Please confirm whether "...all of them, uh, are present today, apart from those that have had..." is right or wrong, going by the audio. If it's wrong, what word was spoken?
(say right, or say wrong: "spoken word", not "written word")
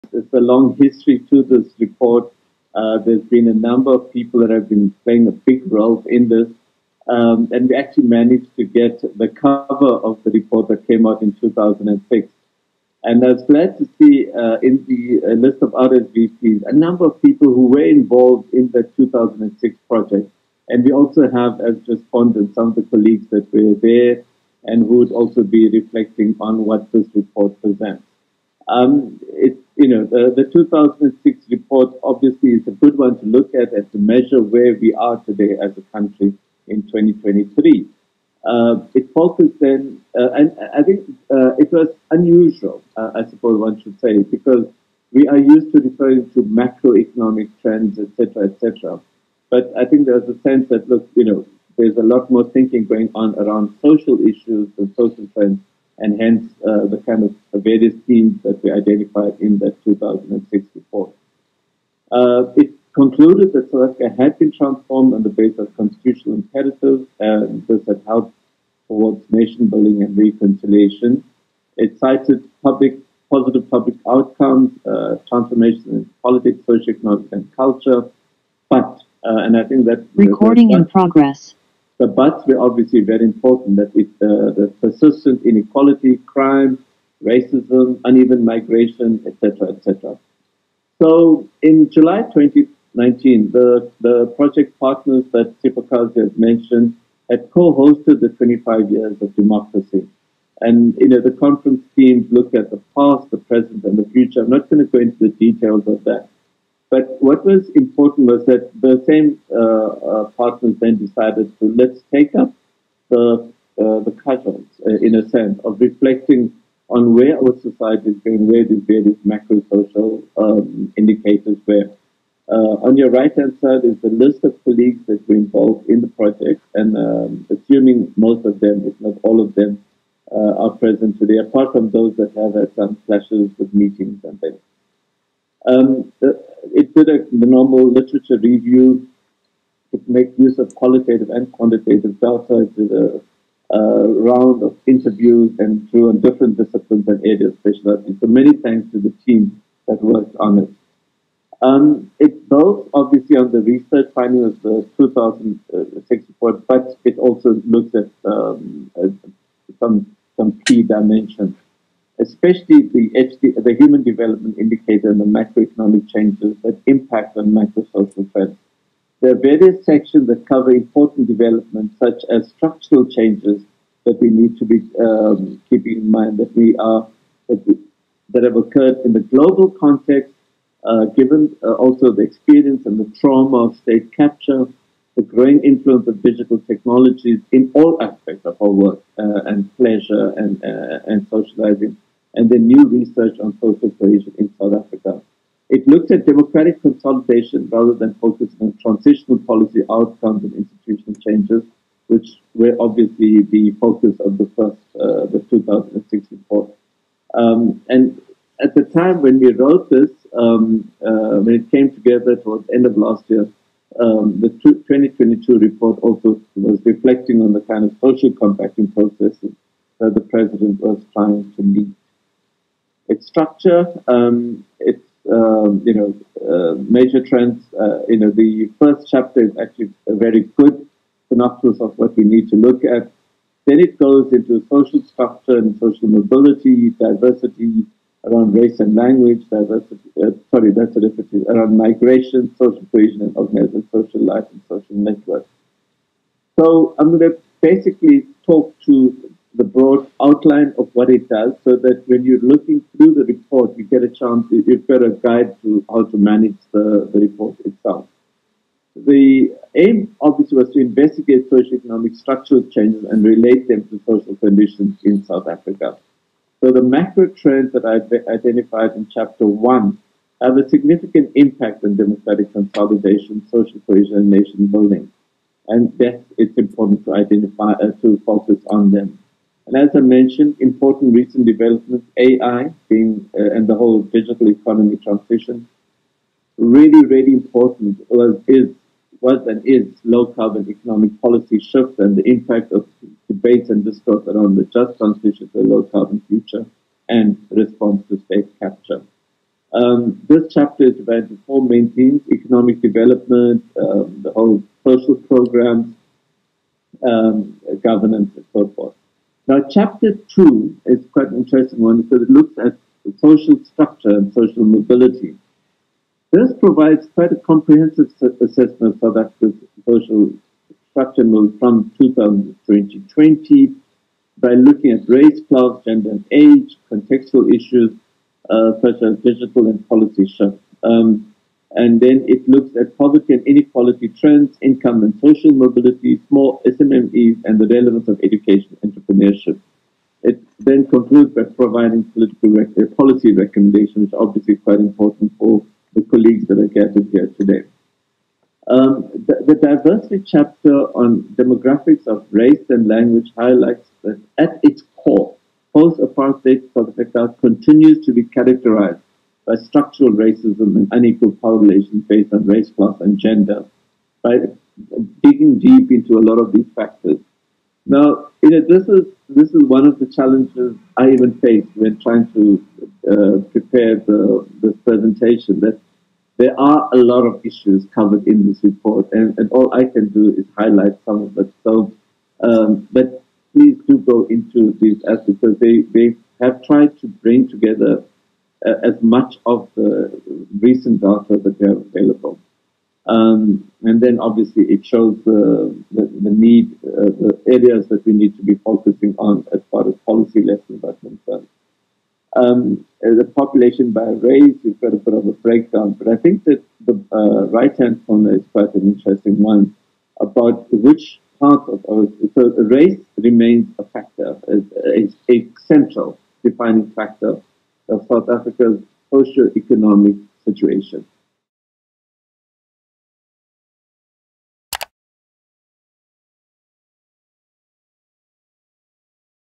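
right.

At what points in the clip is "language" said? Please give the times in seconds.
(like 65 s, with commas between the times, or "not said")
238 s, 352 s.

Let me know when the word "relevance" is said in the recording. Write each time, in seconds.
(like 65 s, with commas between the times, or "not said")
337 s.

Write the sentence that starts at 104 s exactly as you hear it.
I'm not going to go into the details of that.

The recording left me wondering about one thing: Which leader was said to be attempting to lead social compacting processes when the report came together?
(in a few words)
The president.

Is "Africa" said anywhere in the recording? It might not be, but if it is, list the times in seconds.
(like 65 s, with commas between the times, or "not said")
63 s, 194 s, 265 s, 319 s, 356 s, 418 s.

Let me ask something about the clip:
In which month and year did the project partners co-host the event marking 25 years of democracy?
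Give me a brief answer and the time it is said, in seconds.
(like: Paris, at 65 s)
July 2019, at 91 s.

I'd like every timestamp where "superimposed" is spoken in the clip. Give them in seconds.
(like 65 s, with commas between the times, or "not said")
not said.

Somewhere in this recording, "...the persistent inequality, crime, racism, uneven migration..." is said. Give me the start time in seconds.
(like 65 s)
84 s.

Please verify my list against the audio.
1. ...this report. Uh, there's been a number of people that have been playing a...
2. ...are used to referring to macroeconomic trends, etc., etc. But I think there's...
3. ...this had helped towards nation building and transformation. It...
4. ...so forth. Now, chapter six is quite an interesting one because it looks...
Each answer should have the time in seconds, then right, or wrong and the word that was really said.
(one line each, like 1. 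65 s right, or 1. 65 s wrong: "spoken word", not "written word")
1. 1 s right
2. 45 s right
3. 67 s wrong: "reconciliation", not "transformation"
4. 308 s wrong: "two", not "six".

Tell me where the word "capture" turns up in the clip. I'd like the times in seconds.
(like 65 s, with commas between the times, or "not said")
184 s, 298 s.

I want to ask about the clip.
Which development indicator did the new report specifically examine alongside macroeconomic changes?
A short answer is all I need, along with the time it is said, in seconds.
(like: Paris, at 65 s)
Human development indicator, at 163 s.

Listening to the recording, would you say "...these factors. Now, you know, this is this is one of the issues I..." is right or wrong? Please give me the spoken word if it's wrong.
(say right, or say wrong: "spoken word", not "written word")
wrong: "challenges", not "issues".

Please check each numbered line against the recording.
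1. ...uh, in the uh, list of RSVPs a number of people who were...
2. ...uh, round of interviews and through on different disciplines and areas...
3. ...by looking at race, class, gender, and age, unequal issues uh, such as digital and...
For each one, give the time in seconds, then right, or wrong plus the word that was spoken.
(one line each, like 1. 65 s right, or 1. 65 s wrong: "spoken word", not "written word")
1. 14 s right
2. 143 s right
3. 324 s wrong: "contextual", not "unequal".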